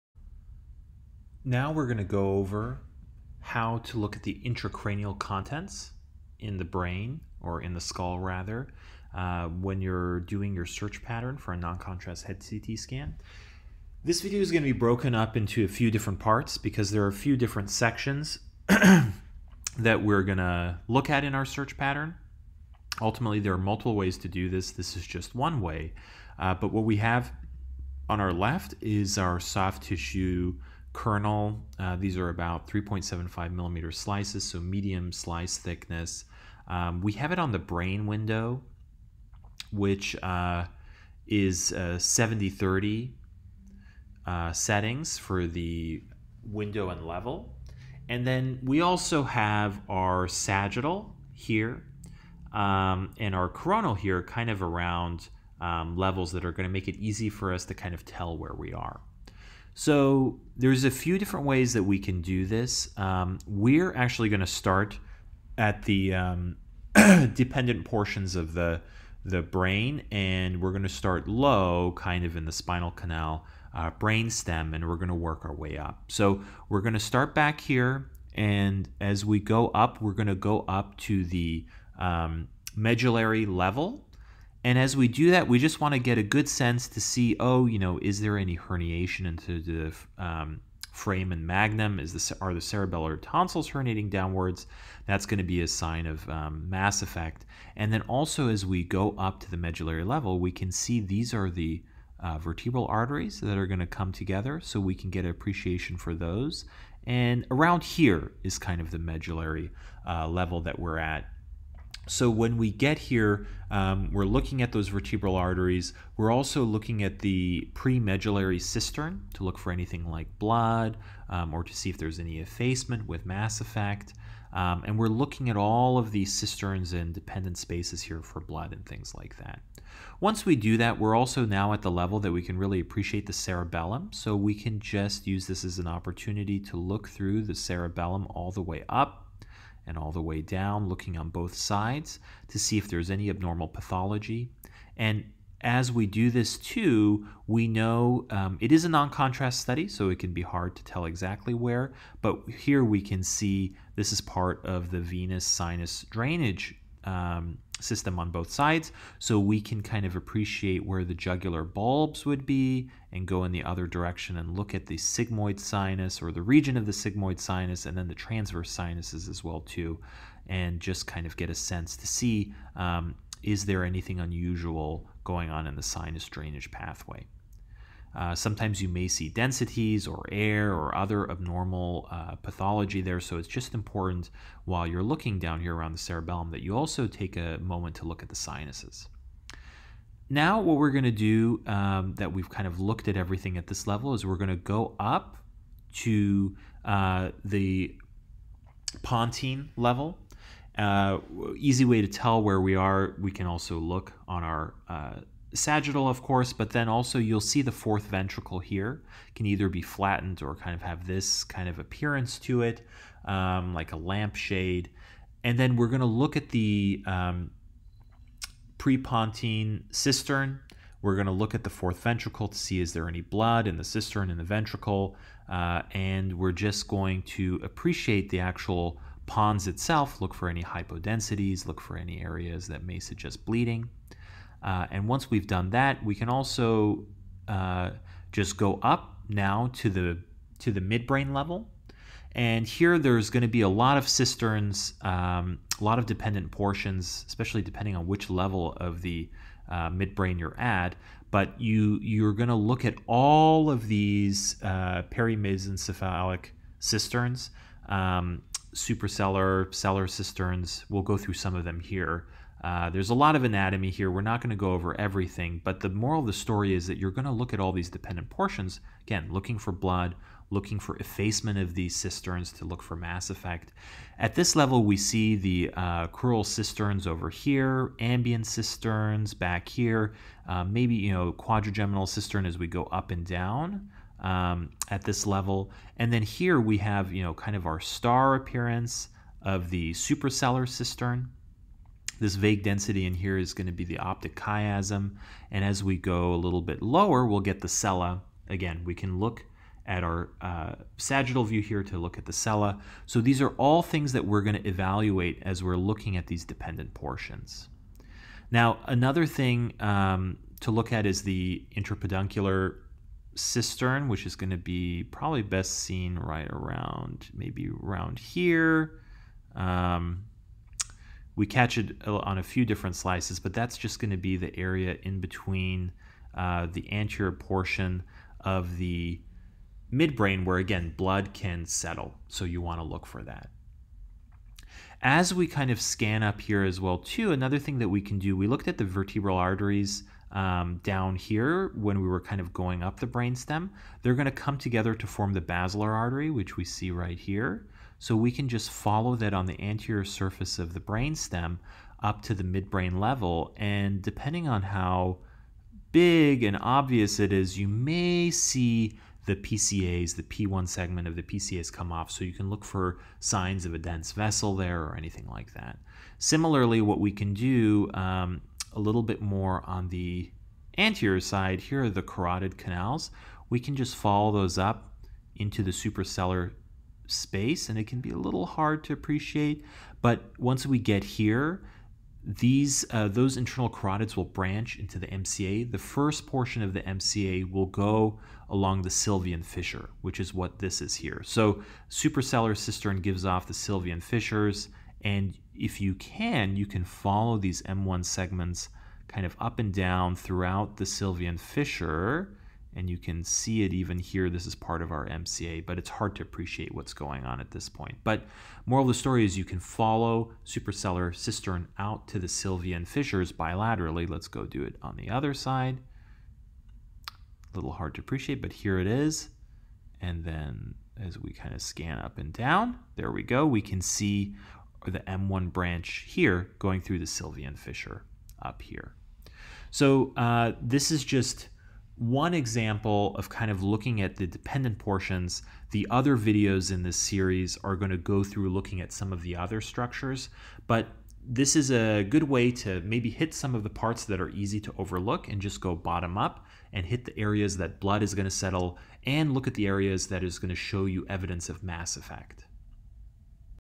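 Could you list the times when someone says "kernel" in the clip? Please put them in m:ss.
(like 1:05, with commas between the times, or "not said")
0:30.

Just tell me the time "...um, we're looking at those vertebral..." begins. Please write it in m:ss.
1:53.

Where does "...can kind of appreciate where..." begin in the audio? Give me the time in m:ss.
2:39.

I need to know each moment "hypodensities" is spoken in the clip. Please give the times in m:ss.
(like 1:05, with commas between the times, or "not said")
3:50.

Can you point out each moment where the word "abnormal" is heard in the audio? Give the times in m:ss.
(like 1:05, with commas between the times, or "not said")
2:23, 3:01.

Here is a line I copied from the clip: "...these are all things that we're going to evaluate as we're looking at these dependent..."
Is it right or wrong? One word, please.
right.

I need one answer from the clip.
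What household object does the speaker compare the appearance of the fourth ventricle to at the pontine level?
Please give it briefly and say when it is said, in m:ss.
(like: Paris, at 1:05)
a lampshade, at 3:33.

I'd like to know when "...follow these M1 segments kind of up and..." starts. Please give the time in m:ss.
6:36.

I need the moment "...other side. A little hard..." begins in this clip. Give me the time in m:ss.
6:55.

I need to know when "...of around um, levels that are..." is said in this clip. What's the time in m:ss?
0:54.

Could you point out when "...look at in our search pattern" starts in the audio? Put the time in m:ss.
0:20.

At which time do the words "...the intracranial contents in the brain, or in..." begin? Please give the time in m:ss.
0:04.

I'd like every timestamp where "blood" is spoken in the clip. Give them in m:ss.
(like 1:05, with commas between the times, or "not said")
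2:00, 2:08, 3:43, 4:29, 5:30, 7:27.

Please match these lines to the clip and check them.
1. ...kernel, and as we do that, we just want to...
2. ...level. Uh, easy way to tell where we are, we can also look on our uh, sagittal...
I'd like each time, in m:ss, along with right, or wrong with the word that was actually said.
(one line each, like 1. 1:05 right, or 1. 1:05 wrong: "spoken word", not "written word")
1. 1:23 wrong: "level", not "kernel"
2. 3:19 right.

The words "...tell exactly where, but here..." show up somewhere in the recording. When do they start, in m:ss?
2:30.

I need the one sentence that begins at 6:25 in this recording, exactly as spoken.
The first portion of the MCA will go along the Sylvian fissure, which is what this is here.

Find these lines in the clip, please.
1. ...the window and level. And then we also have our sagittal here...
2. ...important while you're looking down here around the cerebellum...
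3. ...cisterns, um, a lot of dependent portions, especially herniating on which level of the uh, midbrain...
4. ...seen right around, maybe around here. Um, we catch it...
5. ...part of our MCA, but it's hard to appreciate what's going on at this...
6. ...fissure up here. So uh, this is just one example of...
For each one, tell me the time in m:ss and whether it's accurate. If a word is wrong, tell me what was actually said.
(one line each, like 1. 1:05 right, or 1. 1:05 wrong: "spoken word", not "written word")
1. 0:45 right
2. 3:03 right
3. 4:04 wrong: "depending", not "herniating"
4. 5:15 right
5. 6:44 right
6. 7:07 right.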